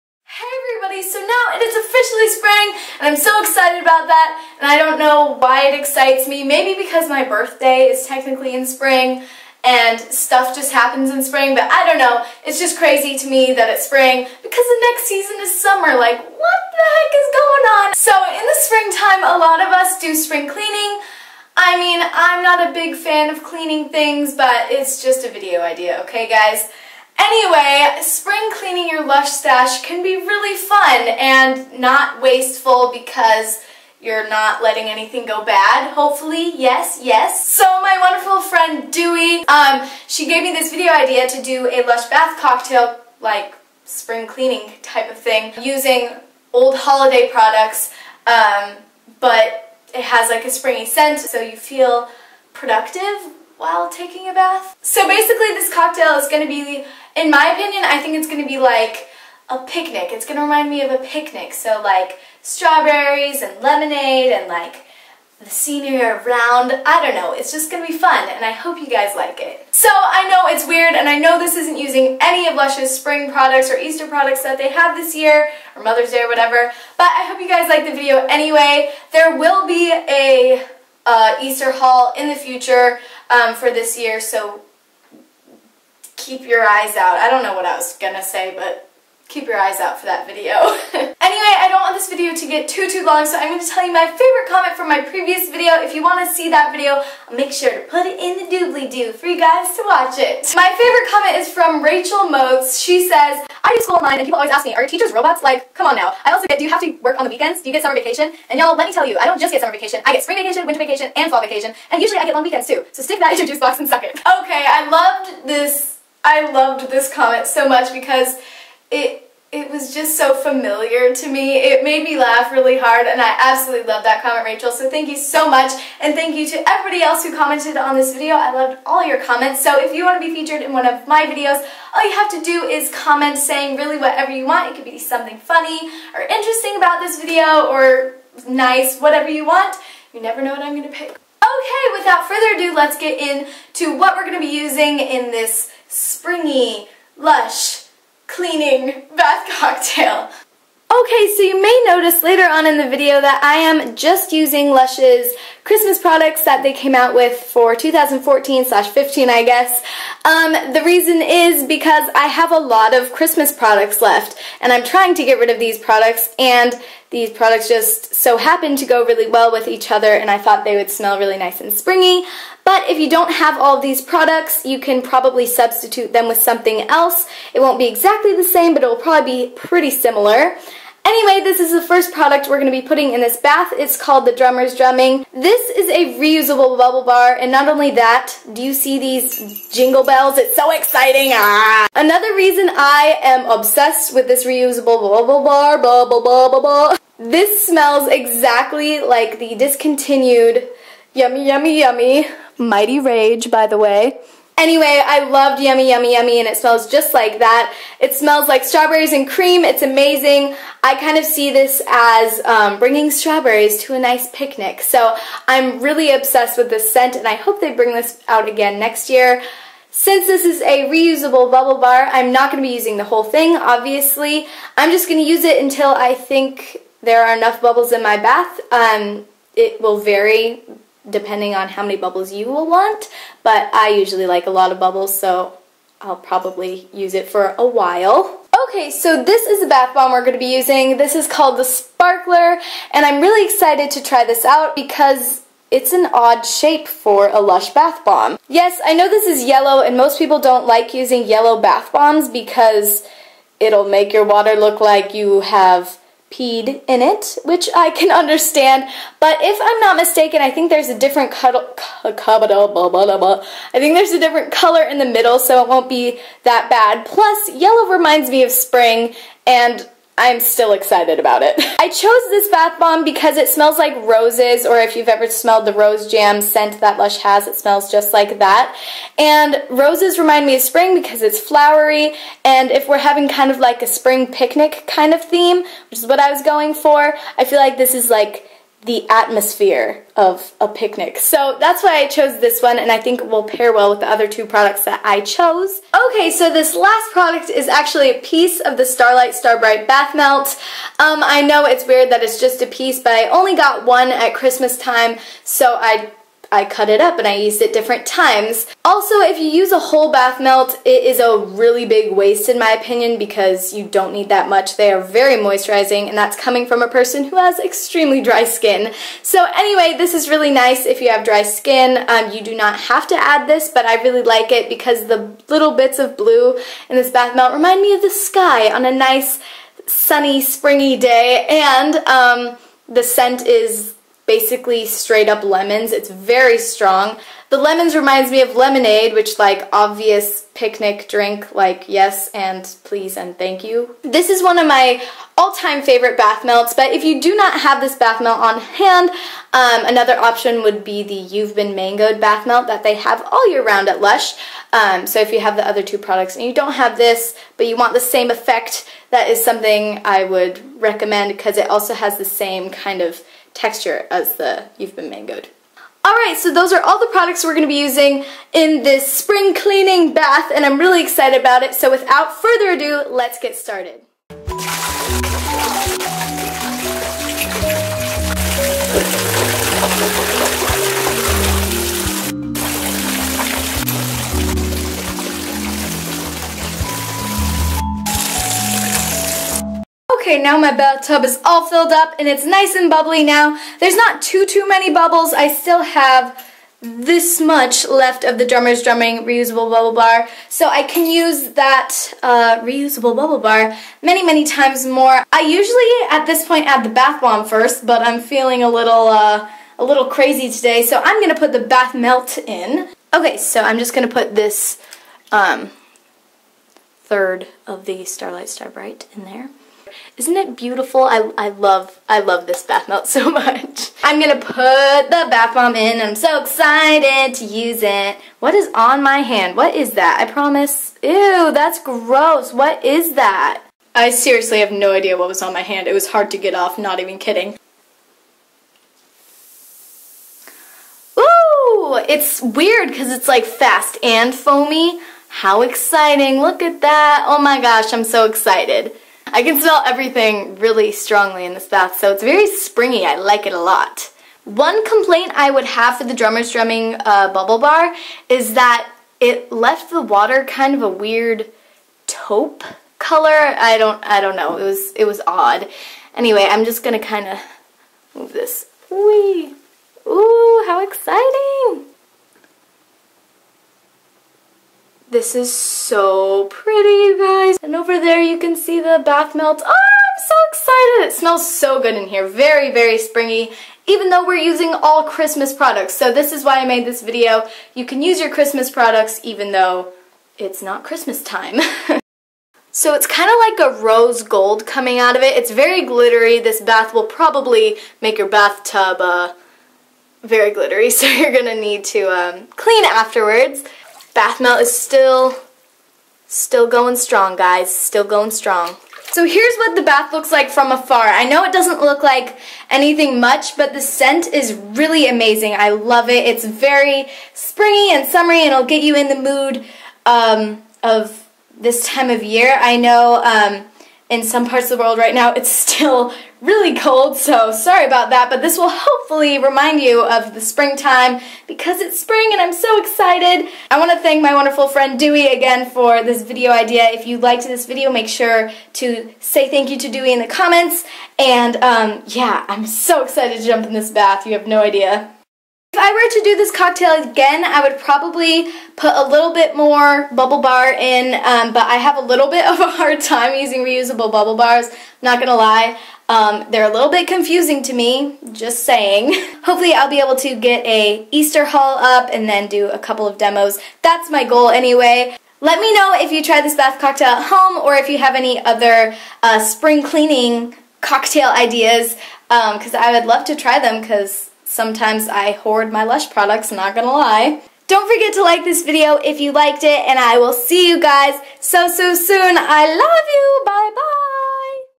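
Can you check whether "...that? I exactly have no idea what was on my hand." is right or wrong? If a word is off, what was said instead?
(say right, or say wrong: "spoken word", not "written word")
wrong: "seriously", not "exactly".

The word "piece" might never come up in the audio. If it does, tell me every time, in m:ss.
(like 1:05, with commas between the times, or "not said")
4:58, 5:02.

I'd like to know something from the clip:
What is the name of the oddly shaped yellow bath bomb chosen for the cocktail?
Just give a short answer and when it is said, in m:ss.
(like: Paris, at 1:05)
Sparkler, at 4:01.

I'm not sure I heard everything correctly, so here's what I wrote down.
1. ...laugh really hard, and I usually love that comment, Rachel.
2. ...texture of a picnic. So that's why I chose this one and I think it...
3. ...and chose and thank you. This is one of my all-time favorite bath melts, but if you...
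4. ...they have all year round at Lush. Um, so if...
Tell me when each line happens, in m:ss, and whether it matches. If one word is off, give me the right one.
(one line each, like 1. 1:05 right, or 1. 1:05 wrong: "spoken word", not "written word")
1. 2:02 wrong: "absolutely", not "usually"
2. 4:49 wrong: "atmosphere", not "texture"
3. 5:42 wrong: "please", not "chose"
4. 5:52 right.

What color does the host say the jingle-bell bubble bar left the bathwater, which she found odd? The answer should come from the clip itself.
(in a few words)
taupe.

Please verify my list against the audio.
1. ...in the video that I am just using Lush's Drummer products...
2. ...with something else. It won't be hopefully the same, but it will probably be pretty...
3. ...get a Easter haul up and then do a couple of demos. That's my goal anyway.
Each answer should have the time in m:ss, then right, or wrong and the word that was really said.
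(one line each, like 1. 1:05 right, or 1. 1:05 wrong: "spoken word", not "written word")
1. 2:32 wrong: "Christmas", not "Drummer"
2. 2:56 wrong: "exactly", not "hopefully"
3. 9:20 right.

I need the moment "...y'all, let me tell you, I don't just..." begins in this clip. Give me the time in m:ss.
1:48.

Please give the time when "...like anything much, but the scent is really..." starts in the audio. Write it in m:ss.
8:32.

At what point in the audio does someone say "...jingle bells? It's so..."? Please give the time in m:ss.
3:09.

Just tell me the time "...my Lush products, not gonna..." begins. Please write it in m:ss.
9:35.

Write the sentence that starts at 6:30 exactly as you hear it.
Okay, now my bathtub is all filled up and it's nice and bubbly now.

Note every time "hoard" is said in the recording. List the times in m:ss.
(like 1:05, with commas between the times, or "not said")
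9:35.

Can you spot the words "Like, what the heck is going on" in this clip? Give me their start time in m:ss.
0:15.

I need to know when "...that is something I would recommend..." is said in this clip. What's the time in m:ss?
5:59.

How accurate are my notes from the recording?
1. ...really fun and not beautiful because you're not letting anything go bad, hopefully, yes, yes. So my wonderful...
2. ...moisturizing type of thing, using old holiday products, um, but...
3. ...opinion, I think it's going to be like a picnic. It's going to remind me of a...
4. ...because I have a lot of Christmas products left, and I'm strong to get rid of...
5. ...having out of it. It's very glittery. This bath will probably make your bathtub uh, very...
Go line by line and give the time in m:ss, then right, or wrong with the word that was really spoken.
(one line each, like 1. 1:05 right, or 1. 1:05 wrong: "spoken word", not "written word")
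1. 0:30 wrong: "wasteful", not "beautiful"
2. 0:44 wrong: "cleaning", not "moisturizing"
3. 0:57 right
4. 2:41 wrong: "trying", not "strong"
5. 8:14 wrong: "coming", not "having".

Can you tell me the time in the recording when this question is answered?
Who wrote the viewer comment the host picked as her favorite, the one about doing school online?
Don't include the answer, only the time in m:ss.
1:41.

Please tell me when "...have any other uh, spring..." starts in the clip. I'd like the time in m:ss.
9:27.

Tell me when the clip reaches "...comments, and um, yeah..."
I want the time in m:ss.
9:00.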